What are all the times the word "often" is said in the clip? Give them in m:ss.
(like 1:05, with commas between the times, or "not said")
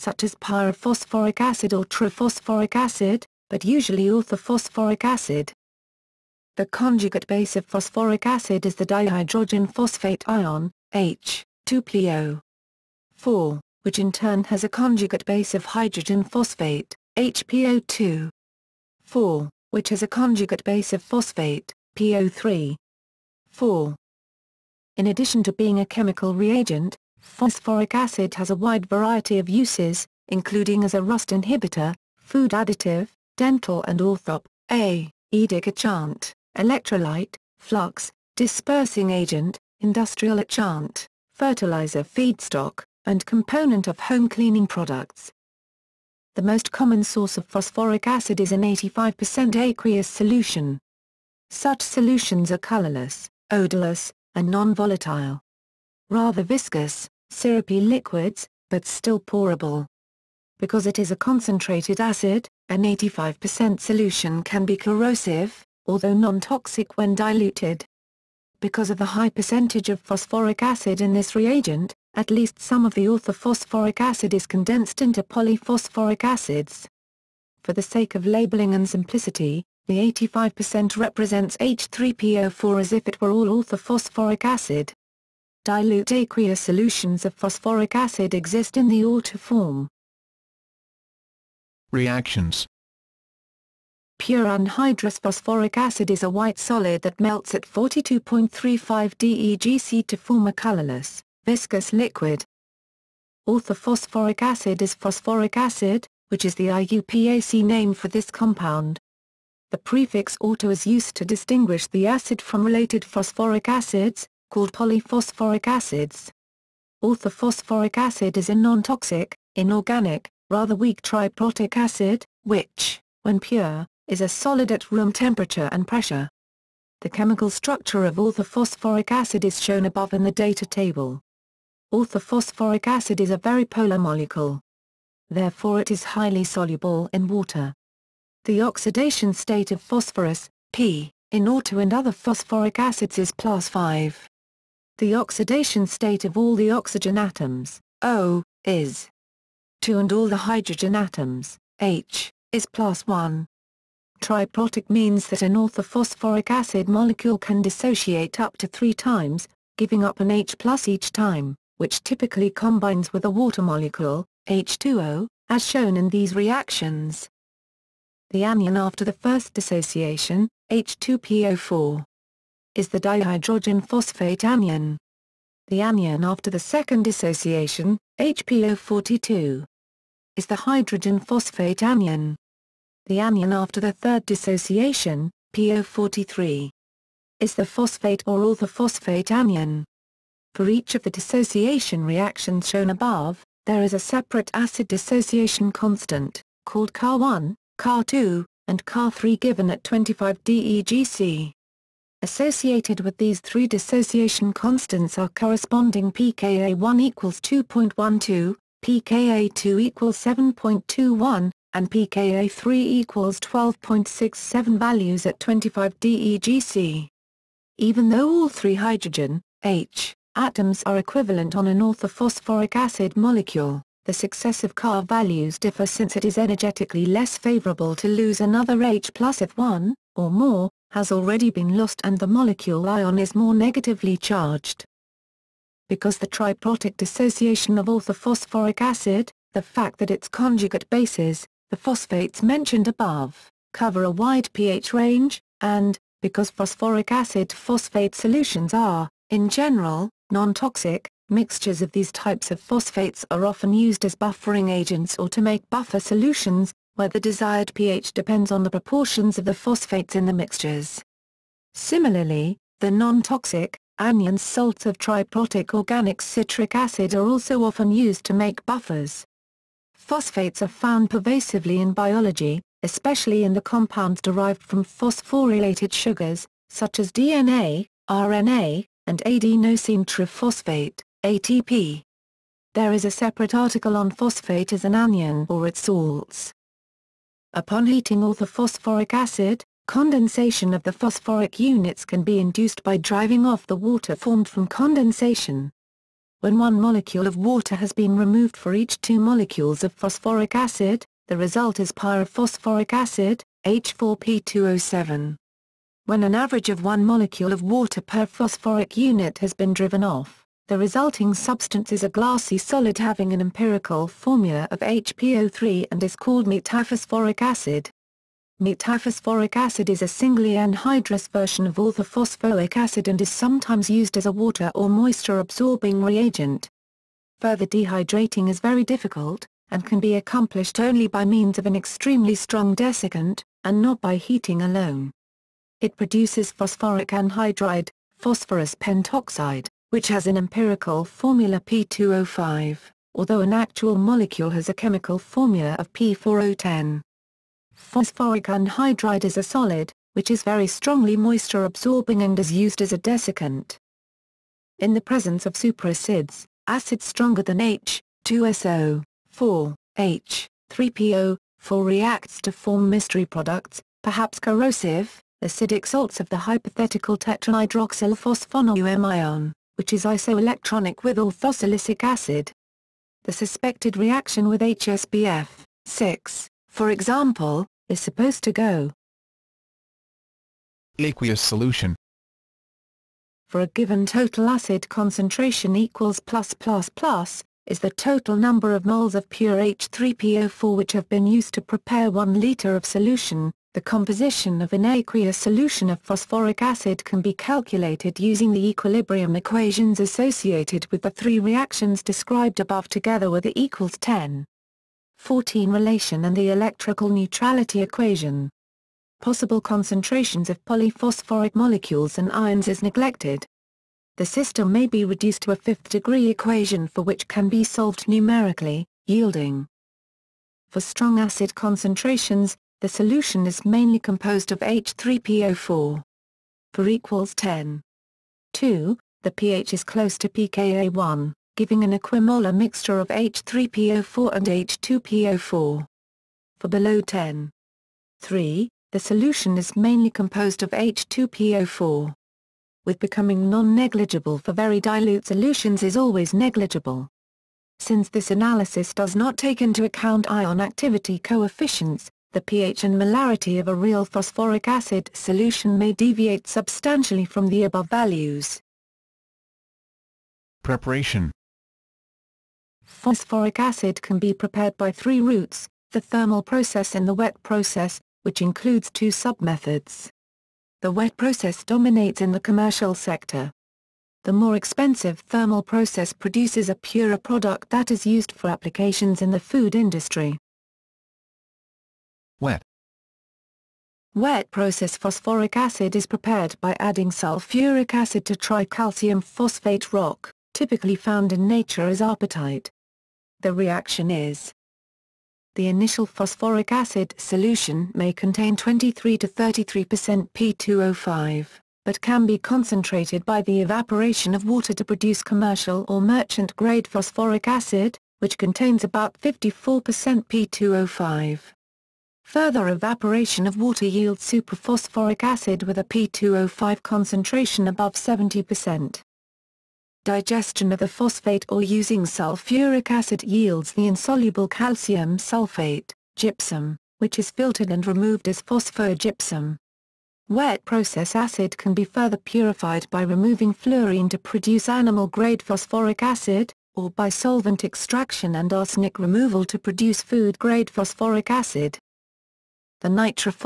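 4:13, 4:27.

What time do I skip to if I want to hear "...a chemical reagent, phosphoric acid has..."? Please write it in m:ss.
0:25.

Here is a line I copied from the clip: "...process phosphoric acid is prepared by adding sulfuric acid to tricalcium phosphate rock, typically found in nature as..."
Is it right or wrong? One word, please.
right.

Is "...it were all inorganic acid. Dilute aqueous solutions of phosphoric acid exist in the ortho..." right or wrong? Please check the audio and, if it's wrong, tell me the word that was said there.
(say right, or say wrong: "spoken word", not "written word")
wrong: "orthophosphoric", not "inorganic".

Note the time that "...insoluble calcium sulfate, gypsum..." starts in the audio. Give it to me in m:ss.
8:43.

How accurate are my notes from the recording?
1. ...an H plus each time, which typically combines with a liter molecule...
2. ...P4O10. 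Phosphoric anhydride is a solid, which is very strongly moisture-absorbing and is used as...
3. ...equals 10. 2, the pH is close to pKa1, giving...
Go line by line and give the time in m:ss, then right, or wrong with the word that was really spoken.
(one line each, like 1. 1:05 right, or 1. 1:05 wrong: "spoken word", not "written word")
1. 2:40 wrong: "water", not "liter"
2. 5:45 right
3. 7:06 right.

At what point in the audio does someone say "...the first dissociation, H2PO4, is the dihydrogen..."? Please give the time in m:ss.
2:49.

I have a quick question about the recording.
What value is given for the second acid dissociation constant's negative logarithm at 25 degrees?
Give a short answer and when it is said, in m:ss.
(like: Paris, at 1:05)
7.21, at 3:30.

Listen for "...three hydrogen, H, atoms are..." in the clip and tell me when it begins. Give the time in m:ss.
3:38.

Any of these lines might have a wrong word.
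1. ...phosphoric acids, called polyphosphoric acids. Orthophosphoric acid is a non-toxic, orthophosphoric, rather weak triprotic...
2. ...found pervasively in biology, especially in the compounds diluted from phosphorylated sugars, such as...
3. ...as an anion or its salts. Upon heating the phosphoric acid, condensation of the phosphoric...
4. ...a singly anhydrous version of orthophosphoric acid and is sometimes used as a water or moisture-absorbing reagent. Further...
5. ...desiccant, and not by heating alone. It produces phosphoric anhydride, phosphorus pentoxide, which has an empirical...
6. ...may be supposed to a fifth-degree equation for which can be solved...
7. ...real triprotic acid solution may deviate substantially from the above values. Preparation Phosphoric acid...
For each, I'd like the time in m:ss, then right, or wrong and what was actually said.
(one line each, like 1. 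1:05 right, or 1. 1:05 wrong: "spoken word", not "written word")
1. 1:53 wrong: "inorganic", not "orthophosphoric"
2. 4:30 wrong: "derived", not "diluted"
3. 4:44 right
4. 5:20 right
5. 5:32 right
6. 6:54 wrong: "reduced", not "supposed"
7. 7:33 wrong: "phosphoric", not "triprotic".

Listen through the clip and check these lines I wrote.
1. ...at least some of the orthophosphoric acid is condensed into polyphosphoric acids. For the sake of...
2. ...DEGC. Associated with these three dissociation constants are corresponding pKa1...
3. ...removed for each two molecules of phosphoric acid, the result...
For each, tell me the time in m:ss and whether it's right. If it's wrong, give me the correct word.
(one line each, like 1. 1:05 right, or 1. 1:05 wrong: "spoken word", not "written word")
1. 1:12 right
2. 3:20 right
3. 4:58 right.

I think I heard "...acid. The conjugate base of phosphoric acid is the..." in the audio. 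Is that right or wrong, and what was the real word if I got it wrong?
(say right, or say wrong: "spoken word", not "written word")
right.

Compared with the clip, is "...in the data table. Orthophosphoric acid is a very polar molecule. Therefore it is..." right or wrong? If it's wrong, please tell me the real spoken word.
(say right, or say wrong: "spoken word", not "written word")
right.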